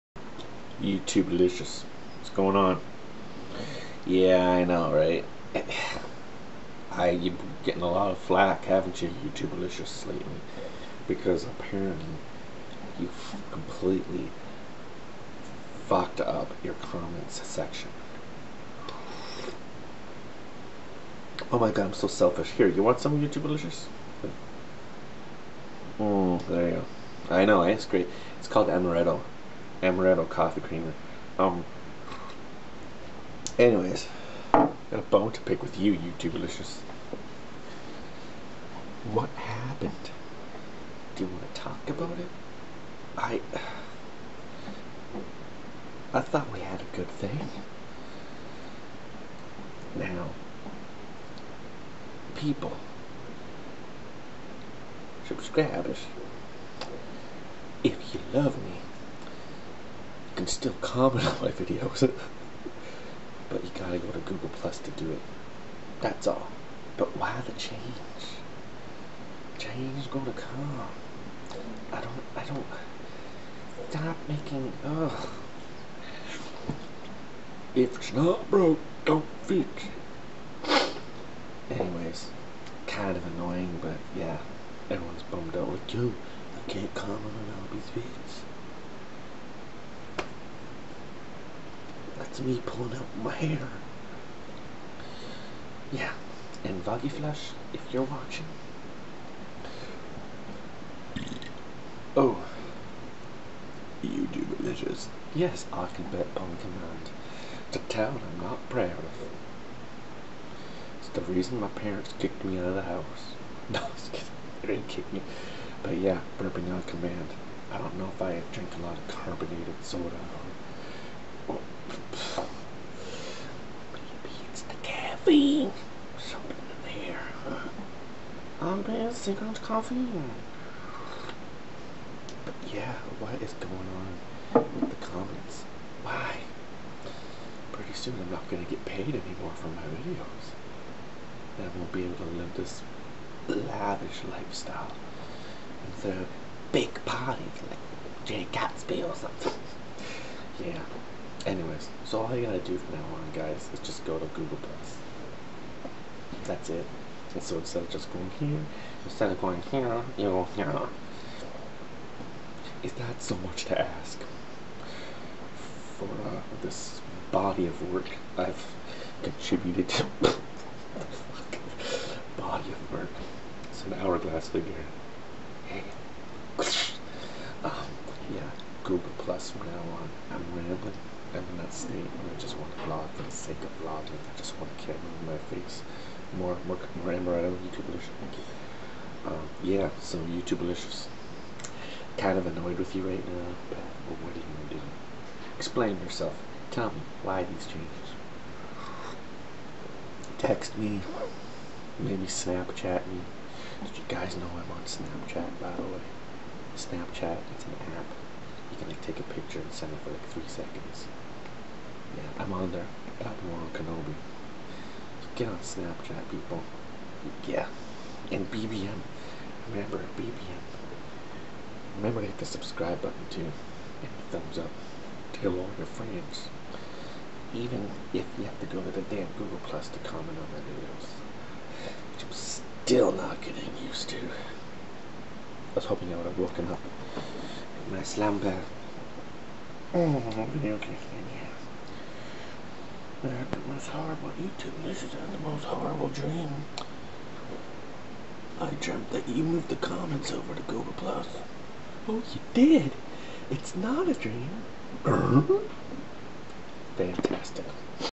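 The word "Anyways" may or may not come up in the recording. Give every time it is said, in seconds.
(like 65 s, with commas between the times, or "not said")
33 s, 81 s, 151 s.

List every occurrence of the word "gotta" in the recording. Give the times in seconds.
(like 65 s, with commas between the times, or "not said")
63 s, 152 s.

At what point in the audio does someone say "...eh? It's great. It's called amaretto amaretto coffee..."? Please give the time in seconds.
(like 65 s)
27 s.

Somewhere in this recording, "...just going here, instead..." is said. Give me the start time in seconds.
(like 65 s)
157 s.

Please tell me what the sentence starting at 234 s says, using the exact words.
I was hoping I would have woken up in my slumber.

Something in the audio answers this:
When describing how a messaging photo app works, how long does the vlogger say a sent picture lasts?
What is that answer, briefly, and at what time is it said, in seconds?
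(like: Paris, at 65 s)
3 seconds, at 210 s.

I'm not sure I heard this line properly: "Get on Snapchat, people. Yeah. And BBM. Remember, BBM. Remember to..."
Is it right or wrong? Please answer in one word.
right.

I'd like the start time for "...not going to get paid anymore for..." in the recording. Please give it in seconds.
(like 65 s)
138 s.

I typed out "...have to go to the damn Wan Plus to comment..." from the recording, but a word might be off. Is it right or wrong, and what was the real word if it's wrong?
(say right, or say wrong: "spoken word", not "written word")
wrong: "Google", not "Wan".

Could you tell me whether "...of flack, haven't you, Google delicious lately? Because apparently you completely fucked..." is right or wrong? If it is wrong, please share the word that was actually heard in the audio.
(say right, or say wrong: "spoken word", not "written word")
wrong: "YouTube", not "Google".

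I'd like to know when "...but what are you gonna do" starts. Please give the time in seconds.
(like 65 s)
193 s.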